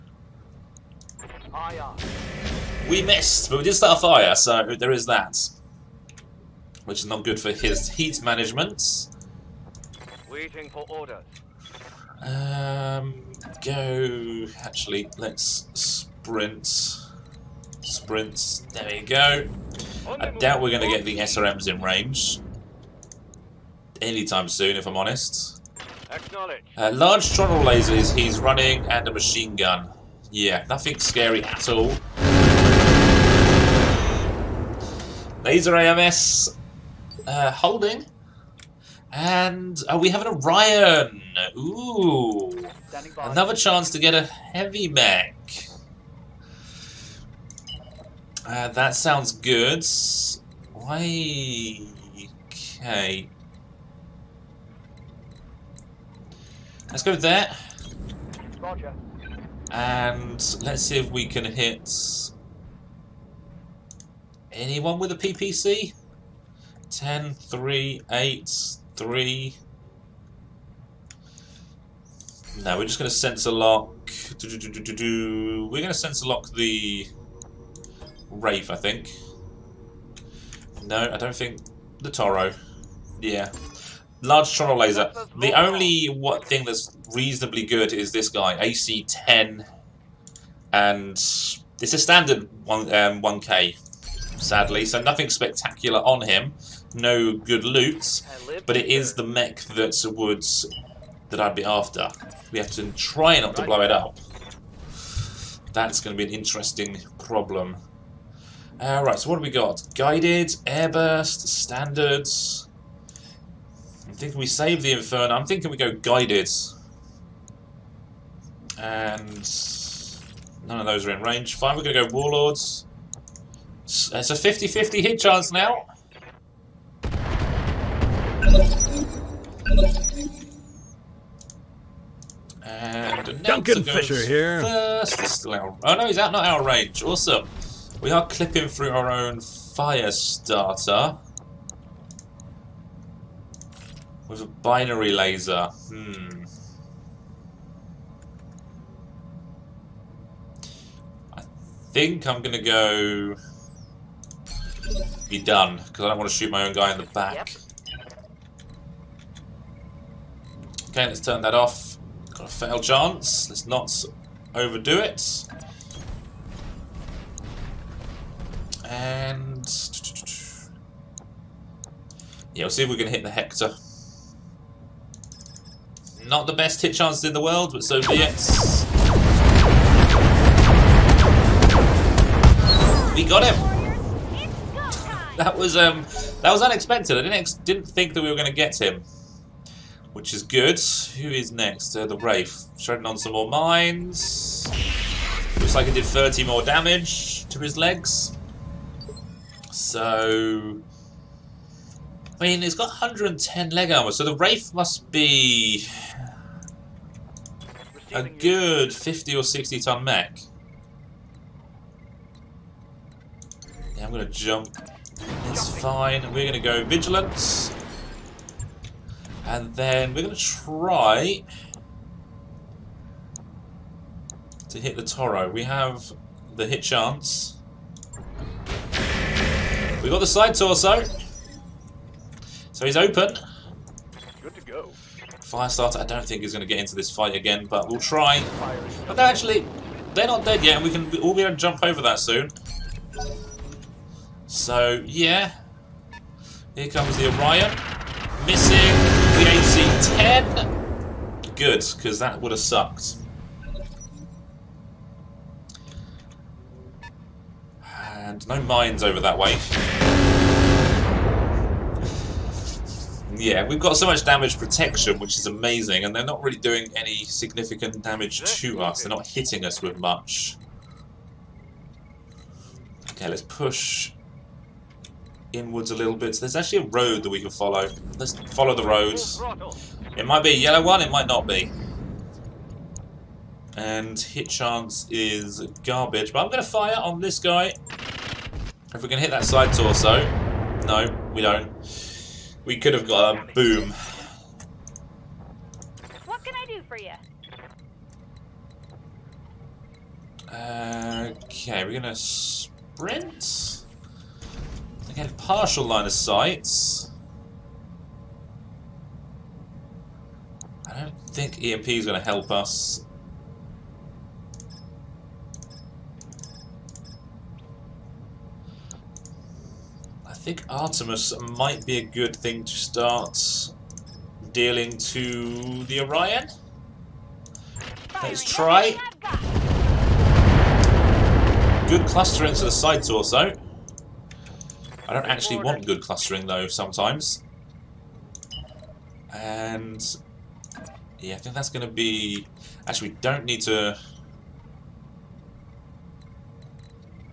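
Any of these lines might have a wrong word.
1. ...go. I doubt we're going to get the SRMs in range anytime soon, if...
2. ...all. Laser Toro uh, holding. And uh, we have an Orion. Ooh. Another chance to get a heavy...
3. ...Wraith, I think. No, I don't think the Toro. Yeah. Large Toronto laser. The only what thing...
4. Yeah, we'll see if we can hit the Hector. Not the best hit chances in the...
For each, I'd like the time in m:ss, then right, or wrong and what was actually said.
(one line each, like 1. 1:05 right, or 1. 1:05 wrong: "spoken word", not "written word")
1. 0:19 right
2. 0:31 wrong: "AMS", not "Toro"
3. 1:18 right
4. 2:52 right.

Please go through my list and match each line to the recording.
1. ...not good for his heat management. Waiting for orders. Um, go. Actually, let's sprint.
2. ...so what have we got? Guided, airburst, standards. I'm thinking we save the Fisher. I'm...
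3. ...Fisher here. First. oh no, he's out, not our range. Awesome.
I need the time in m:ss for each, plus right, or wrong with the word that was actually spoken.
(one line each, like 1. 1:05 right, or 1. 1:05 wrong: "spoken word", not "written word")
1. 0:07 right
2. 1:49 wrong: "Inferno", not "Fisher"
3. 2:13 right.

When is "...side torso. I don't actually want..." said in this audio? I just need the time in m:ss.
5:32.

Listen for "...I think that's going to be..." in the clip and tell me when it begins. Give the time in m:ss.
5:41.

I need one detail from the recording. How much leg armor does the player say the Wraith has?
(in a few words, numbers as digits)
110.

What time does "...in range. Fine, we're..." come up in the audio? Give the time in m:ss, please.
2:01.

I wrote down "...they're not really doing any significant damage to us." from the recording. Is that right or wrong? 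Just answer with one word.
right.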